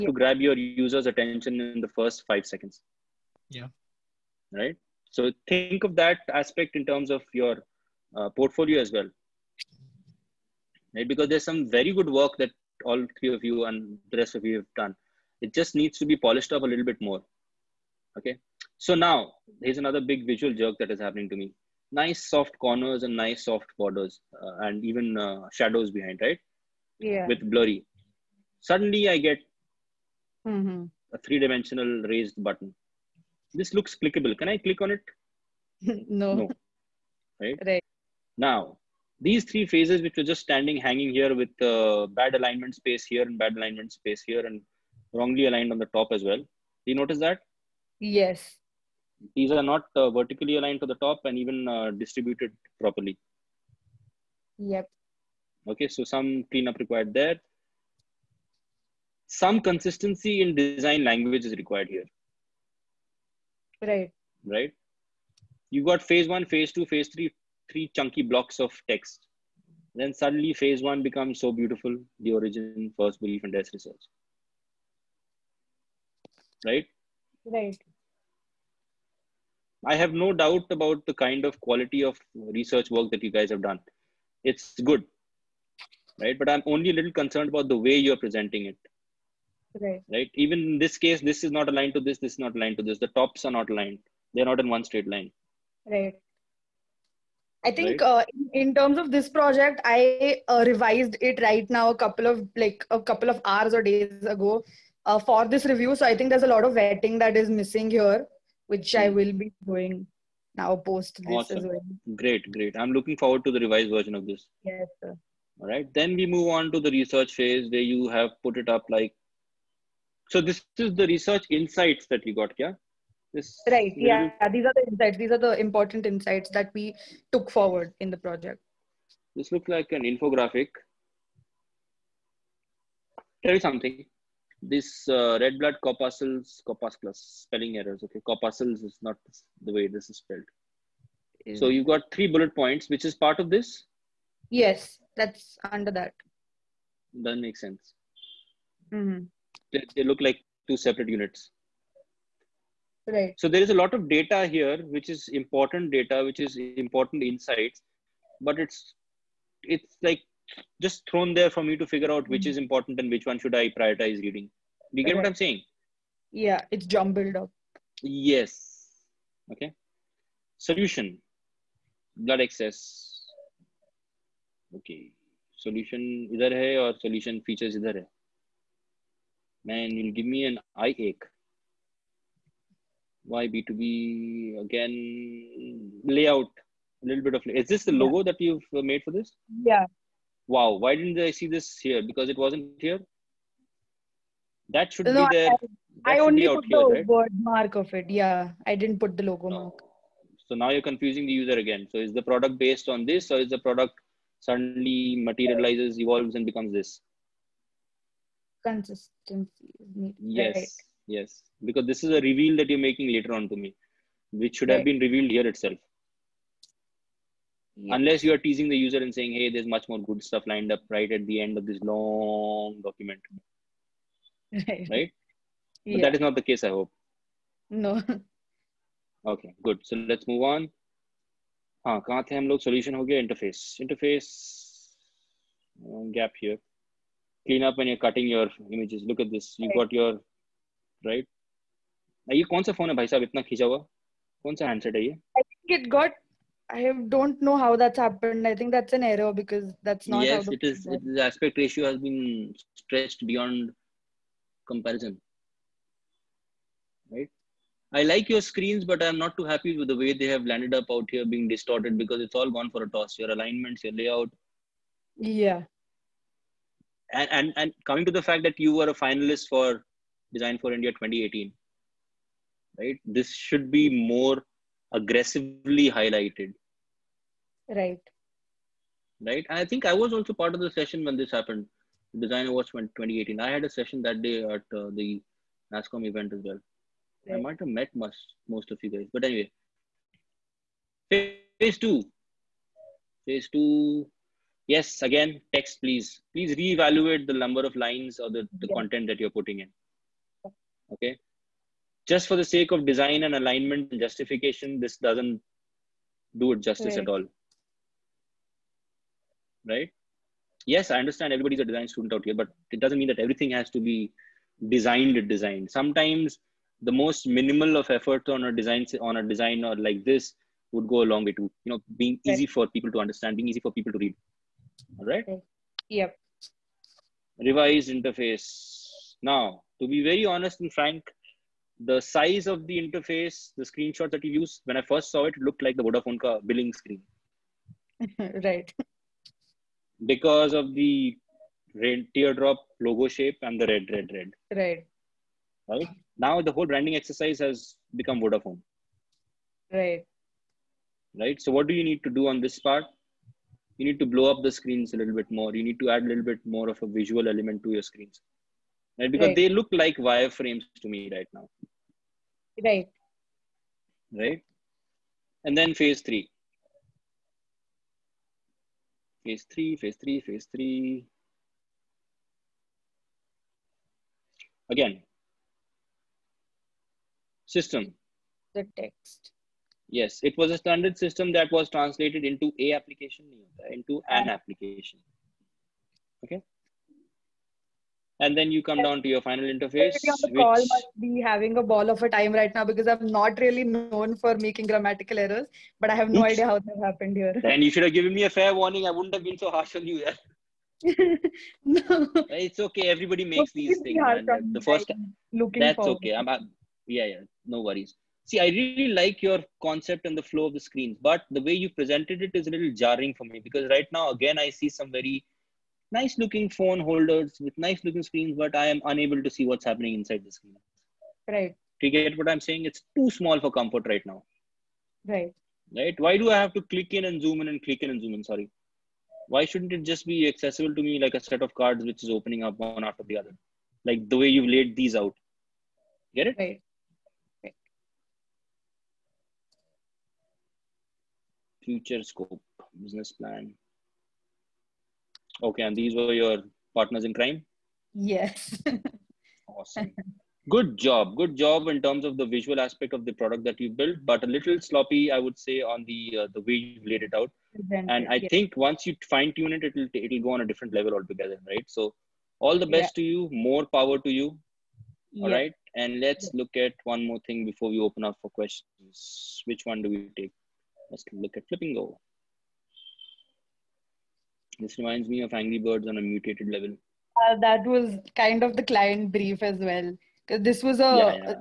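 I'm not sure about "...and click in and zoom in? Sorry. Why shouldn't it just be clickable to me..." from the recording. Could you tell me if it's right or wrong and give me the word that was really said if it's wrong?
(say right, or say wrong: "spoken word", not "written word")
wrong: "accessible", not "clickable".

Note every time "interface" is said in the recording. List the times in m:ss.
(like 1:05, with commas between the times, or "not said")
3:53, 5:27, 5:32, 6:29.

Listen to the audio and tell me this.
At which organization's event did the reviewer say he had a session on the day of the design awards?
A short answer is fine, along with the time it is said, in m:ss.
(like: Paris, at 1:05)
NASSCOM, at 4:45.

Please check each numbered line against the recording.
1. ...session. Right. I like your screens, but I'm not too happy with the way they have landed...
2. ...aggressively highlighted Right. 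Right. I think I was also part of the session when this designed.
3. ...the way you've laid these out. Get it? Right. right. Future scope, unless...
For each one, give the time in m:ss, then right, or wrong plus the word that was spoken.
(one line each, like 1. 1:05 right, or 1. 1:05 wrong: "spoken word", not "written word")
1. 4:14 wrong: "comparison", not "session"
2. 4:34 wrong: "happened", not "designed"
3. 7:14 wrong: "business", not "unless".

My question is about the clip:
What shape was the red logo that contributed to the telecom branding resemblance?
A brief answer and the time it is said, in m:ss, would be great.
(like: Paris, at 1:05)
teardrop, at 5:42.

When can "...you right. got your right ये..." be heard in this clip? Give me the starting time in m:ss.
3:59.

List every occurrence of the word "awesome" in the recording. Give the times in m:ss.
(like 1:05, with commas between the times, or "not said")
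1:51, 7:29.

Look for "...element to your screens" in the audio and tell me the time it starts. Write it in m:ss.
5:57.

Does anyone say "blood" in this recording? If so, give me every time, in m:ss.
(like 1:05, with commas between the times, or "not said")
2:15, 2:52.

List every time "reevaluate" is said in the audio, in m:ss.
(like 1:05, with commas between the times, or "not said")
4:56.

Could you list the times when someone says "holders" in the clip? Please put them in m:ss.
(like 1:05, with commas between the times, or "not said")
6:56.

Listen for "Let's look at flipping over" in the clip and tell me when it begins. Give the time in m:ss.
7:50.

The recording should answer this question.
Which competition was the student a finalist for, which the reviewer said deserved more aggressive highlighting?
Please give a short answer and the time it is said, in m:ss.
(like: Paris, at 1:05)
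Design for India 2018, at 4:30.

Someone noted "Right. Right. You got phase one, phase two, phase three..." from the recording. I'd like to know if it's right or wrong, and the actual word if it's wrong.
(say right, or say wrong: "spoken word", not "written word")
right.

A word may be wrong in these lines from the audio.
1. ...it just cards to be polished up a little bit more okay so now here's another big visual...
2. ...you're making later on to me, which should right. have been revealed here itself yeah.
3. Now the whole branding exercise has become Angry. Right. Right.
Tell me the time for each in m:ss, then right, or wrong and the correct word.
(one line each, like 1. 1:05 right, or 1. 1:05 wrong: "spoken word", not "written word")
1. 0:15 wrong: "needs", not "cards"
2. 3:32 right
3. 5:46 wrong: "Vodafone", not "Angry".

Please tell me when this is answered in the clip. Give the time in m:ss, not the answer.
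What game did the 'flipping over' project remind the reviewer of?
7:55.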